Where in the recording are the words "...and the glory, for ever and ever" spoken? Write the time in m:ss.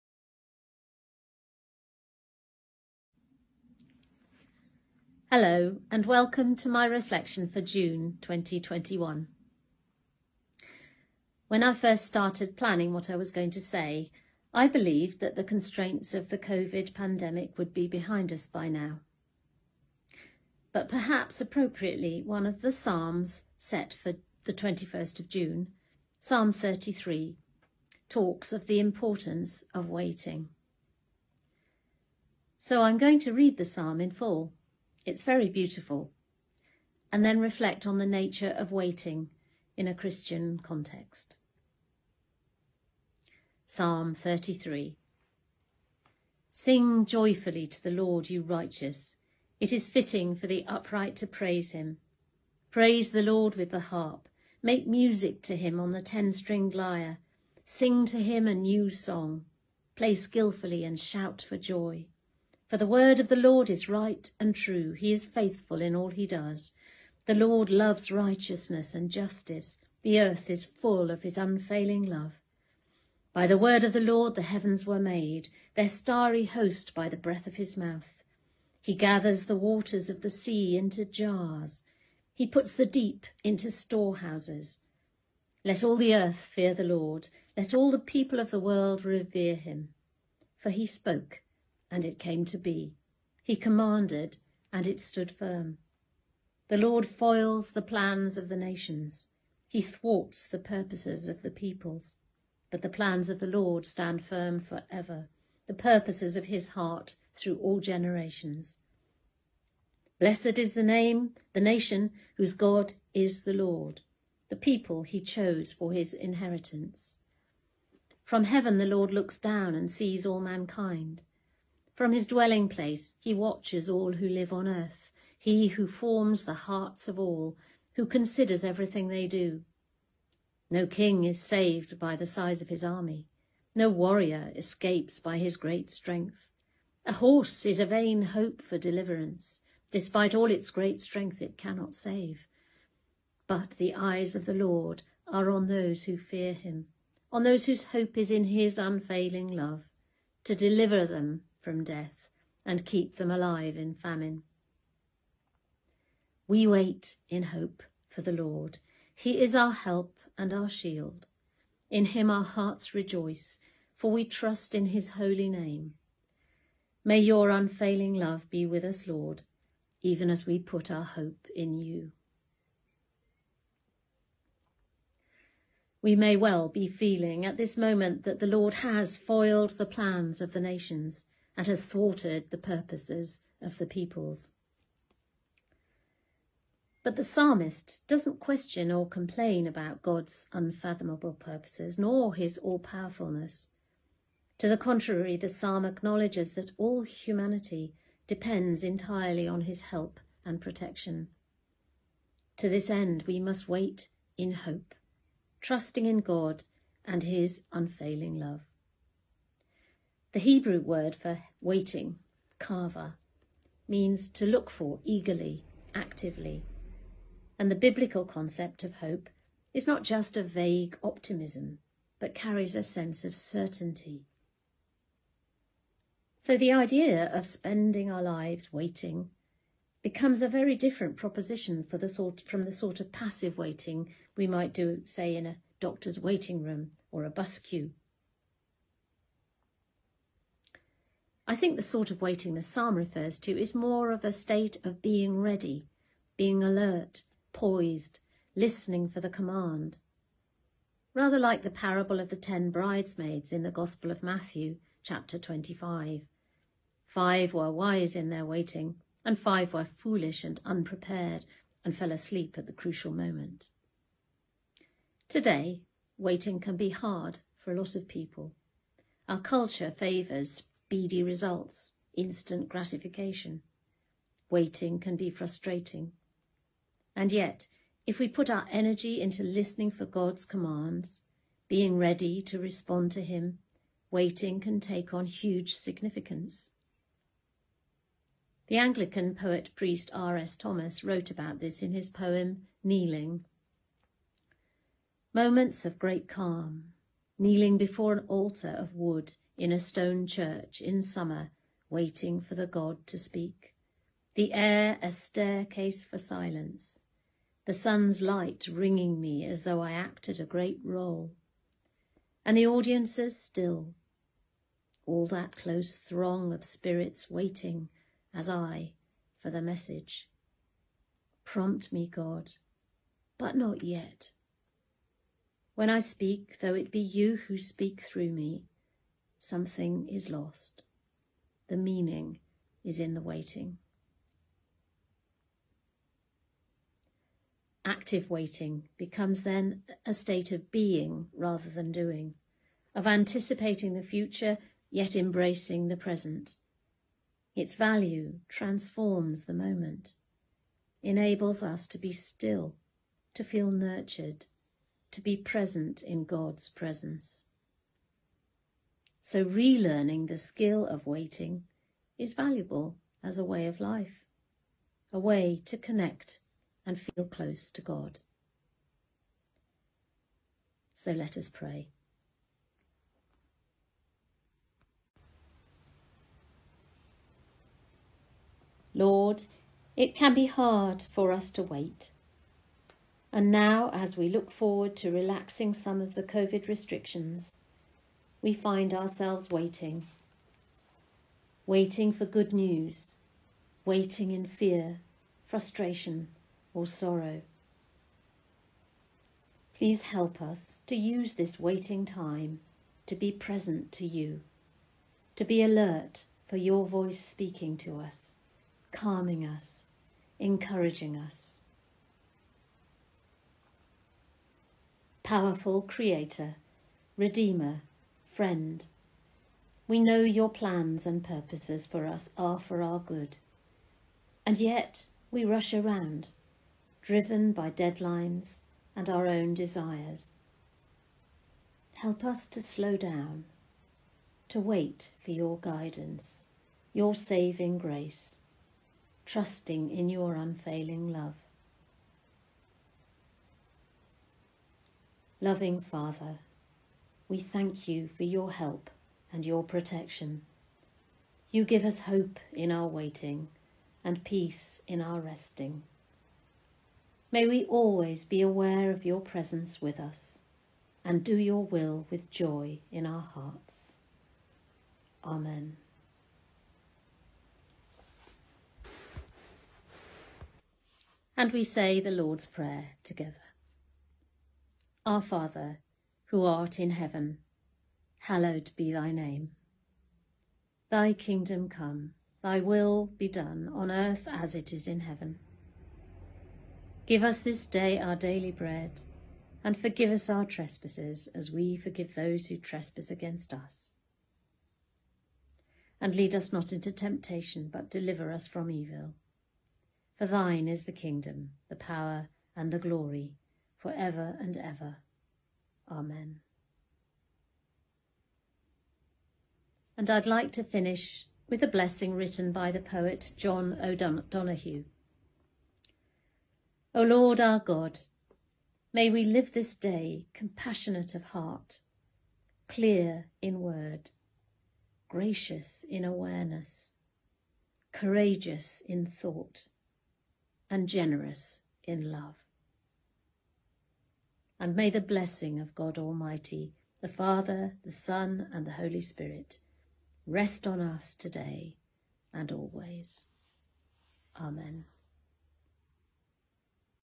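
8:22.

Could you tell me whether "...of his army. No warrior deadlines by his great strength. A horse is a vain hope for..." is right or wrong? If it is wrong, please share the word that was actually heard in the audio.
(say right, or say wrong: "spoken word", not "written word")
wrong: "escapes", not "deadlines".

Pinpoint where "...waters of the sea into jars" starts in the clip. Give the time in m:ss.
1:19.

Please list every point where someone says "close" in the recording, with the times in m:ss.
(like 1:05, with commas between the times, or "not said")
5:15, 6:07.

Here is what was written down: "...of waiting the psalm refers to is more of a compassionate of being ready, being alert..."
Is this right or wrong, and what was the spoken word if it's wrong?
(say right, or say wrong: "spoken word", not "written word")
wrong: "state", not "compassionate".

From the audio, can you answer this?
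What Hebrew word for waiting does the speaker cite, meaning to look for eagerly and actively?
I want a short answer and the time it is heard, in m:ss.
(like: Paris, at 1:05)
kava, at 3:32.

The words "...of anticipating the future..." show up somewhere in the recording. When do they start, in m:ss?
5:42.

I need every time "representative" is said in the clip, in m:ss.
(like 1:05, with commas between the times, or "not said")
not said.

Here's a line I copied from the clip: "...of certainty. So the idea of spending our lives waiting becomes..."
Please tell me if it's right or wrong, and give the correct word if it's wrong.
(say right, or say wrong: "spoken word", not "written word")
right.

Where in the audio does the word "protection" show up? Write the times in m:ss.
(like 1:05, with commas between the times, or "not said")
3:20, 7:29.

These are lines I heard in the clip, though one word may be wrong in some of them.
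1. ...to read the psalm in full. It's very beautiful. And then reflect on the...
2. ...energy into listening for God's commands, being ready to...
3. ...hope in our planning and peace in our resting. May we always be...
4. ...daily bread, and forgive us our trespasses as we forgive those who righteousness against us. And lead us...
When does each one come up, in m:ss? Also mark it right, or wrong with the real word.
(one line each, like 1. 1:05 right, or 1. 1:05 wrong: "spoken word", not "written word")
1. 0:33 right
2. 4:38 right
3. 7:32 wrong: "waiting", not "planning"
4. 8:08 wrong: "trespass", not "righteousness".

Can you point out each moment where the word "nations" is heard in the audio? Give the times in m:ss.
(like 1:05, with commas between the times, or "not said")
1:38, 1:51, 3:00.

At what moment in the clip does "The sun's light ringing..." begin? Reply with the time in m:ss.
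5:07.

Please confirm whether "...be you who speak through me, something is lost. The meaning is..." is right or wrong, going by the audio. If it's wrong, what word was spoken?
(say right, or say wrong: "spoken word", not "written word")
right.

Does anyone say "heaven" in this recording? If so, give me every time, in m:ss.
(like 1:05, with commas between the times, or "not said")
1:14, 1:58, 7:56, 8:04.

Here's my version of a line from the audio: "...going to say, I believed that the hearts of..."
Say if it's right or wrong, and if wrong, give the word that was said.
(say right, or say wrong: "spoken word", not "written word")
wrong: "constraints", not "hearts".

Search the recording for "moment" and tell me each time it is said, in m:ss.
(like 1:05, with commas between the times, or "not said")
2:57, 4:23, 4:55, 5:49.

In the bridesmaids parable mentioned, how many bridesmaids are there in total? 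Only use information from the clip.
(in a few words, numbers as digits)
10.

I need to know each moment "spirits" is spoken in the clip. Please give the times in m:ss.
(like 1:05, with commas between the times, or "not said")
5:16, 8:59.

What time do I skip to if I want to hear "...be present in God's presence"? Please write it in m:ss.
5:55.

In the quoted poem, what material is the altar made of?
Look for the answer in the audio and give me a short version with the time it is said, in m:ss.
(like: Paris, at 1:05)
wood, at 4:58.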